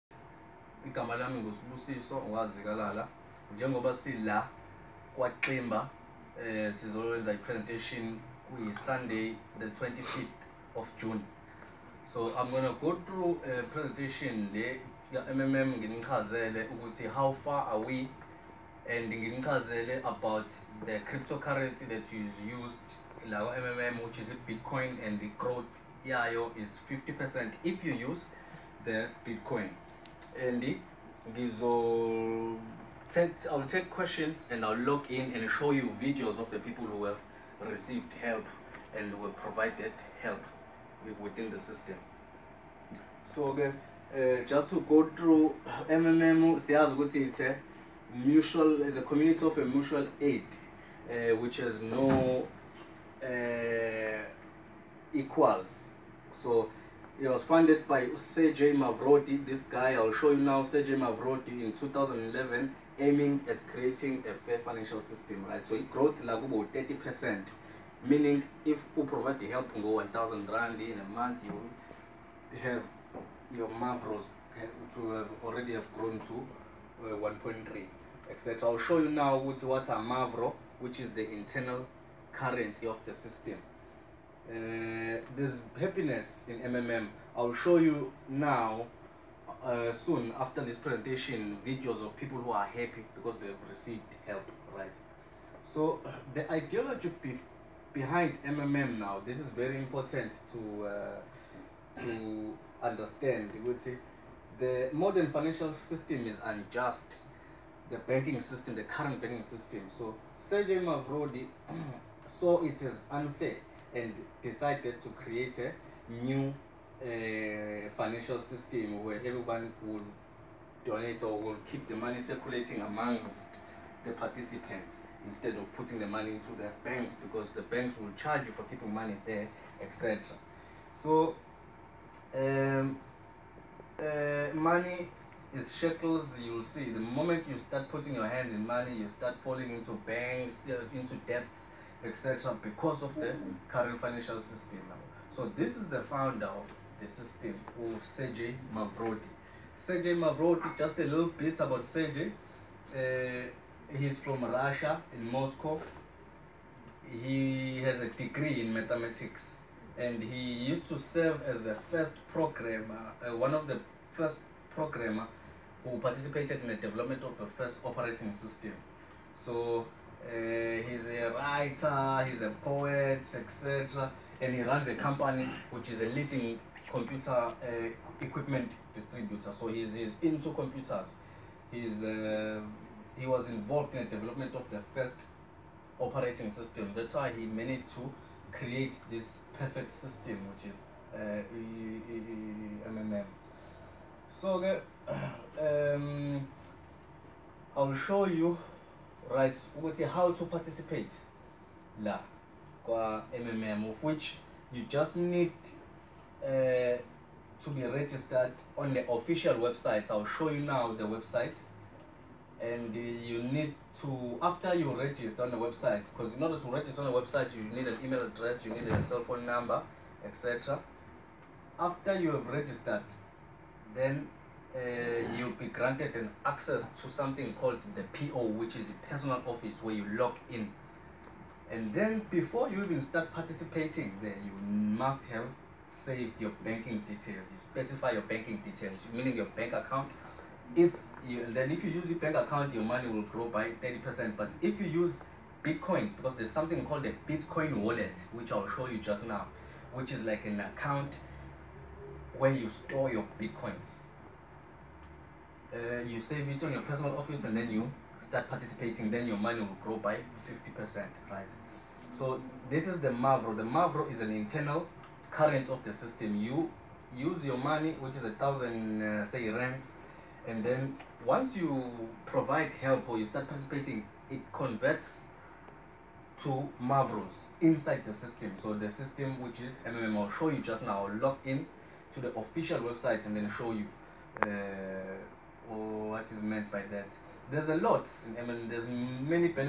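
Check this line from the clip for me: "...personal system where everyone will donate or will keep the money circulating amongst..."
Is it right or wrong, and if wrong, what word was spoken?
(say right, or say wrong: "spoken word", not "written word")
wrong: "financial", not "personal".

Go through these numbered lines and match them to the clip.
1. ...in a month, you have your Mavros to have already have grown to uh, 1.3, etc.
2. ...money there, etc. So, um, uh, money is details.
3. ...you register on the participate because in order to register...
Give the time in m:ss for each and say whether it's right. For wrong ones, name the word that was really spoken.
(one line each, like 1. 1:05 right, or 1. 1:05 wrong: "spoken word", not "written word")
1. 1:10 right
2. 2:08 wrong: "shekels", not "details"
3. 3:34 wrong: "website", not "participate".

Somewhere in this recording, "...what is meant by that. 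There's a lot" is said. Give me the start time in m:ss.
4:46.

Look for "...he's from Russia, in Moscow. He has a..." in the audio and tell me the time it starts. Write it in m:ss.
2:33.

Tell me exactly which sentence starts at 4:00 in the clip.
If you, then if you use your bank account, your money will grow by 30%.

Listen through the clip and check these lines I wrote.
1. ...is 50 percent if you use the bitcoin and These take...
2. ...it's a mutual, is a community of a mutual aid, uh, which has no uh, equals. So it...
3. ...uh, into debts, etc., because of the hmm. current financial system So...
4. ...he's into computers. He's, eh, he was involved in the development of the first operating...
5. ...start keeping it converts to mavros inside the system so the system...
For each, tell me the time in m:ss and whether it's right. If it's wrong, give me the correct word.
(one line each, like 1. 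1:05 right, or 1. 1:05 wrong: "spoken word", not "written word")
1. 0:26 right
2. 0:47 right
3. 2:20 right
4. 2:59 right
5. 4:33 wrong: "participating", not "keeping".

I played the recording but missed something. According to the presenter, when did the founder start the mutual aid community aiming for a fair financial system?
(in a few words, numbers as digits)
2011.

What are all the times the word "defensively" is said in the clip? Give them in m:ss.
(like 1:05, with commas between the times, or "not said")
not said.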